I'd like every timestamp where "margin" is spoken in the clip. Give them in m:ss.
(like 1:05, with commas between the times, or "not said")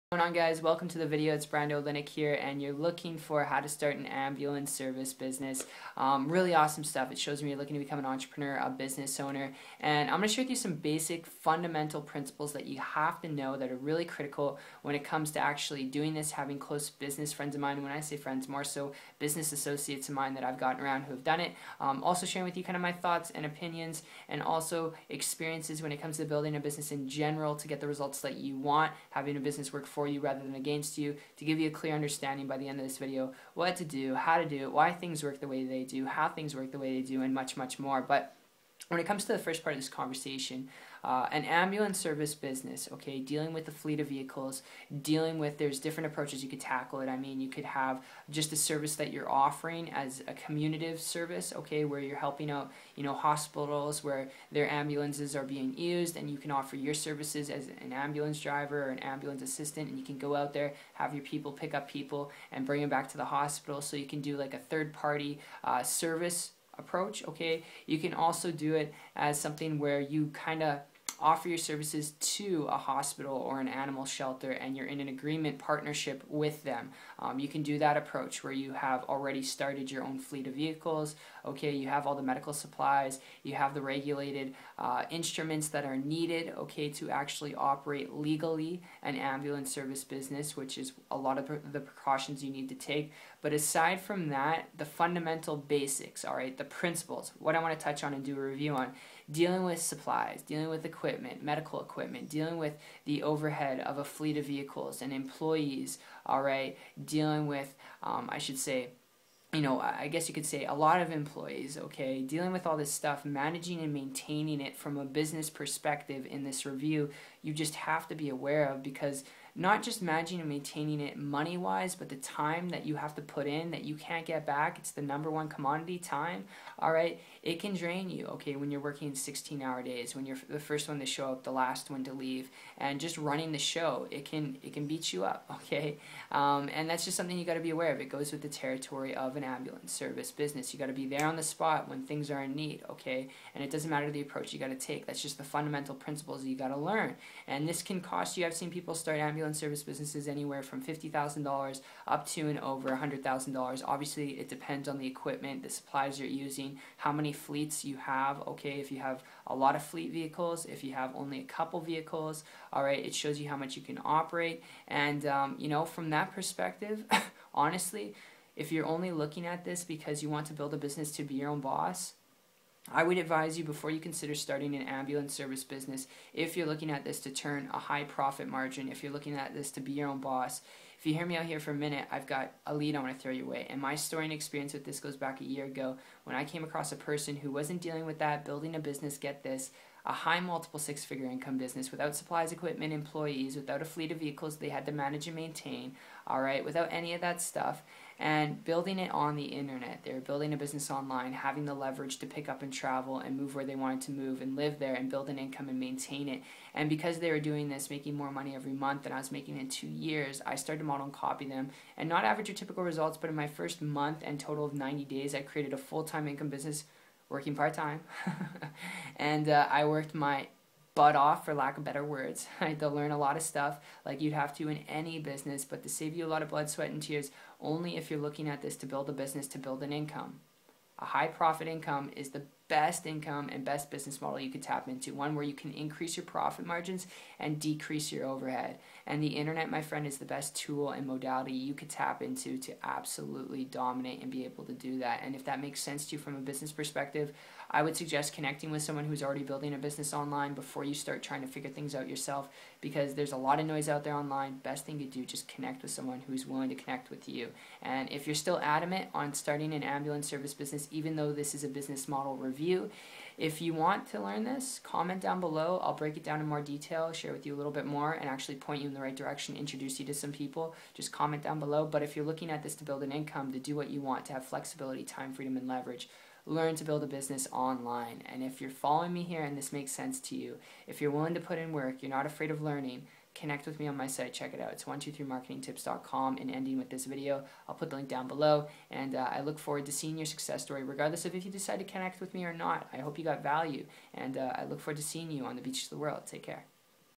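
2:58, 3:56.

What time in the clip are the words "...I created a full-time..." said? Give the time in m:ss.
3:35.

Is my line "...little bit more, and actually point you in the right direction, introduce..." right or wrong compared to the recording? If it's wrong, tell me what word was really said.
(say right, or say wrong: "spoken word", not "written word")
right.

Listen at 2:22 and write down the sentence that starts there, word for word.
Okay, and it doesn't matter the approach you got to take.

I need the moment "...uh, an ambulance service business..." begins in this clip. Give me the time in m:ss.
0:41.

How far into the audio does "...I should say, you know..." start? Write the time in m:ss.
1:48.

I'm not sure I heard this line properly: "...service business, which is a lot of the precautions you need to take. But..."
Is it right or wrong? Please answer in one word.
right.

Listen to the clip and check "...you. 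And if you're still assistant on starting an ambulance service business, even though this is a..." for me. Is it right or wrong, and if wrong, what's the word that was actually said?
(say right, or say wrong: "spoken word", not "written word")
wrong: "adamant", not "assistant".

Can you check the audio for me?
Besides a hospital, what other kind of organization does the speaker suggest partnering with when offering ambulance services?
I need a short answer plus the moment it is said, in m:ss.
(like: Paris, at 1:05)
animal shelter, at 1:13.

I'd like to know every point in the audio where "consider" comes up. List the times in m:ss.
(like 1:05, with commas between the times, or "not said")
2:53.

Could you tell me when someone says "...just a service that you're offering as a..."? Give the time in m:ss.
0:48.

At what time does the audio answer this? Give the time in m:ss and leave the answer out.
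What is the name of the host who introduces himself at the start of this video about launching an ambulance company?
0:01.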